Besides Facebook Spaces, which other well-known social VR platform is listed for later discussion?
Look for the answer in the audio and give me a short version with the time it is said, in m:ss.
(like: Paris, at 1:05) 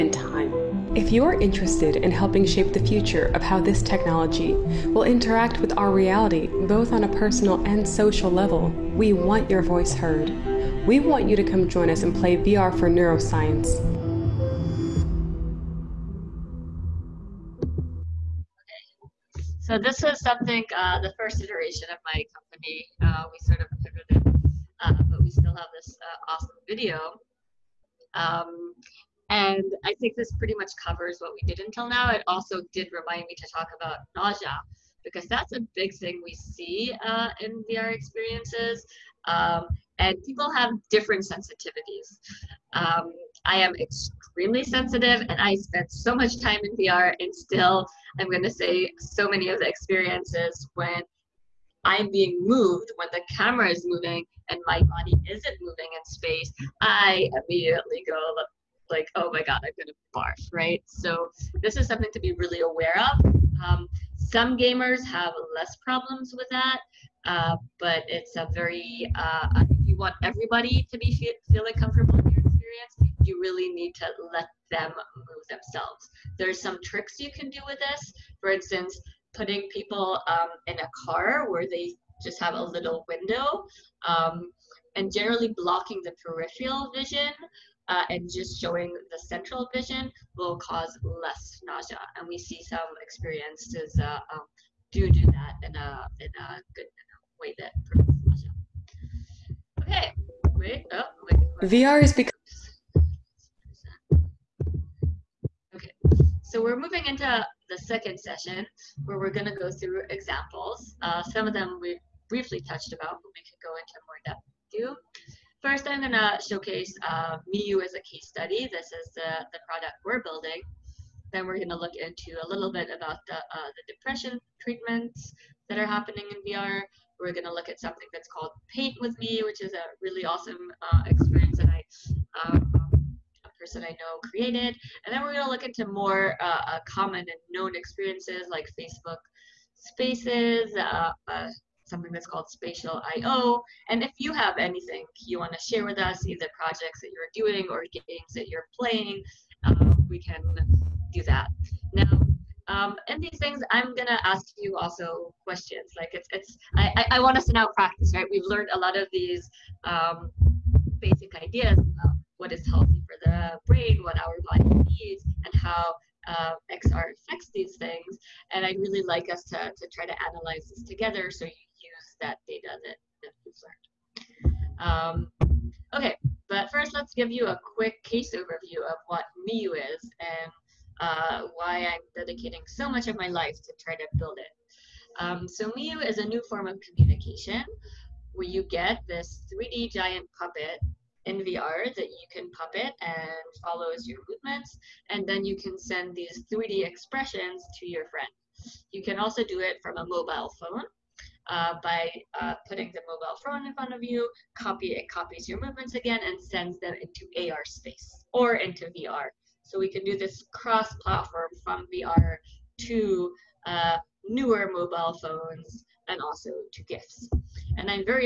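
Spatial I.O, at 2:22.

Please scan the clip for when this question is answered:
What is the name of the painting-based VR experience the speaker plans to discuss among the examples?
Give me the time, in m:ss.
2:08.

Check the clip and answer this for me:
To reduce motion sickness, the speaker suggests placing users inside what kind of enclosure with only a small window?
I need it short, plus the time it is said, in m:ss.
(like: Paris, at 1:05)
A car, at 1:20.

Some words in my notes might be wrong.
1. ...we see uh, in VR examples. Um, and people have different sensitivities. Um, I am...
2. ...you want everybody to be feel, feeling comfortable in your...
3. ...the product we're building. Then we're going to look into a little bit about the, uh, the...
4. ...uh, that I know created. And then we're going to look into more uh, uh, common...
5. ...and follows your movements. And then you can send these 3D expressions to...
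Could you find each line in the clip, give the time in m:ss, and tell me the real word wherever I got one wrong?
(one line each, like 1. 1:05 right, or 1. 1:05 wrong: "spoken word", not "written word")
1. 0:36 wrong: "experiences", not "examples"
2. 1:09 right
3. 1:59 right
4. 2:12 right
5. 3:13 right.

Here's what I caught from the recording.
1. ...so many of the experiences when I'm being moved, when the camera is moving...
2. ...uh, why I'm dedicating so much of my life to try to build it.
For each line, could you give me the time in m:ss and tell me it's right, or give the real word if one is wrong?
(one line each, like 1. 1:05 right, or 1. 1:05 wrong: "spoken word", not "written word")
1. 0:48 right
2. 3:01 right.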